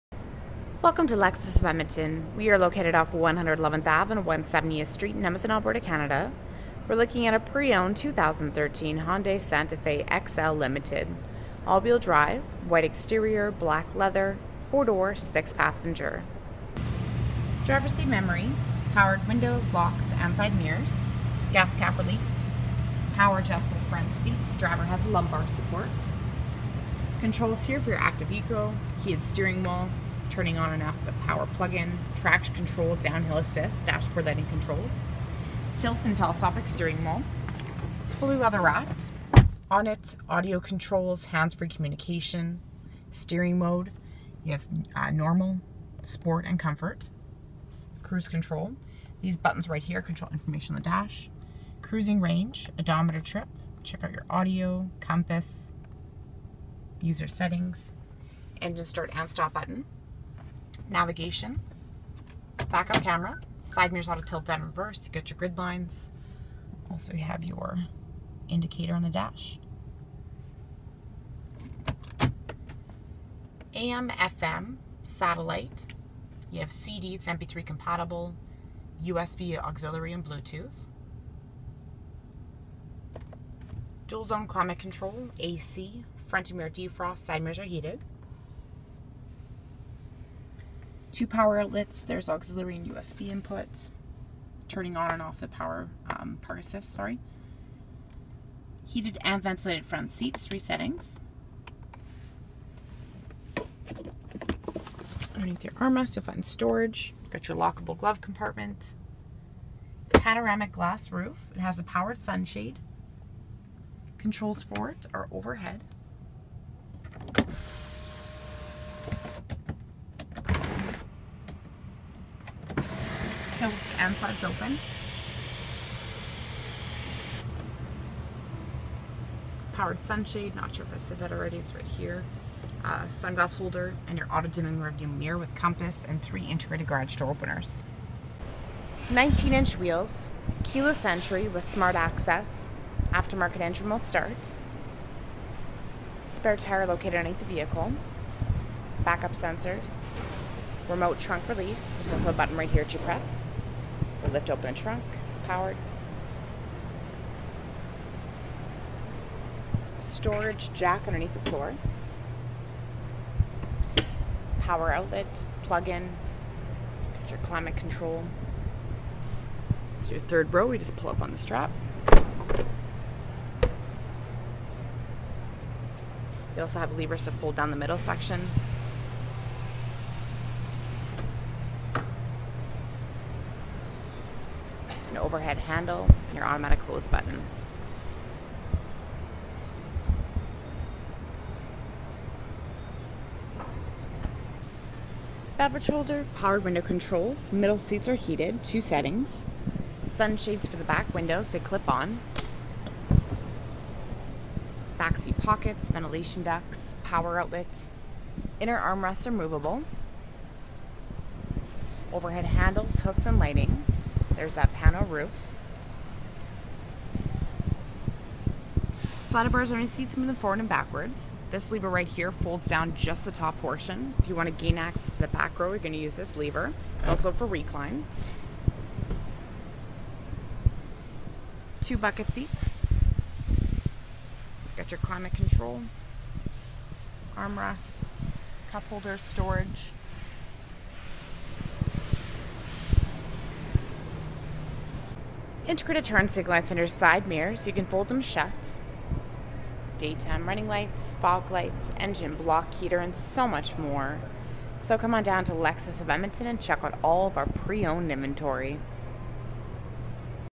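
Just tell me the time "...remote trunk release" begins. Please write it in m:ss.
2:30.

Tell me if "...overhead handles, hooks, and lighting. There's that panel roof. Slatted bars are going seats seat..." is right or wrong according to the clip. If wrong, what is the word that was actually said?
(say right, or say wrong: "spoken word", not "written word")
right.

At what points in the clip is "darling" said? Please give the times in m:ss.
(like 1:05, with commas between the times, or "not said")
not said.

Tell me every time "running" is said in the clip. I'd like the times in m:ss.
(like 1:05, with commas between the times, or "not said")
4:10.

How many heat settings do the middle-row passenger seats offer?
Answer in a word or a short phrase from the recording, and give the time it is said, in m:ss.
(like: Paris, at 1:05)
2, at 3:18.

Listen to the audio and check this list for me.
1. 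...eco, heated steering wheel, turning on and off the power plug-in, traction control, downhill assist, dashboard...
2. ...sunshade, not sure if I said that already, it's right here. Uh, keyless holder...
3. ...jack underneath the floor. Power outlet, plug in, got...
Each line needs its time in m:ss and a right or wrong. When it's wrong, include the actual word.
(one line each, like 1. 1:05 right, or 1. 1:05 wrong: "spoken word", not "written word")
1. 0:28 right
2. 2:10 wrong: "sunglass", not "keyless"
3. 2:40 right.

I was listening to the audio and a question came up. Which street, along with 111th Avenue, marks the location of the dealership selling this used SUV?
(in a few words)
170th Street.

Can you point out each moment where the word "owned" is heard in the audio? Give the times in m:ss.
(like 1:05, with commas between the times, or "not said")
0:07, 4:17.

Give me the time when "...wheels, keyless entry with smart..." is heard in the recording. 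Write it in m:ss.
2:19.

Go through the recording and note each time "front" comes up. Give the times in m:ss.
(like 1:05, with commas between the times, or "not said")
0:23, 1:26, 1:39.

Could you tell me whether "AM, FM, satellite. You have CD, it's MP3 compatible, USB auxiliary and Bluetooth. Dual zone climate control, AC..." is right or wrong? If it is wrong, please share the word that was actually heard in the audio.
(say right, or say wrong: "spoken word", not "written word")
right.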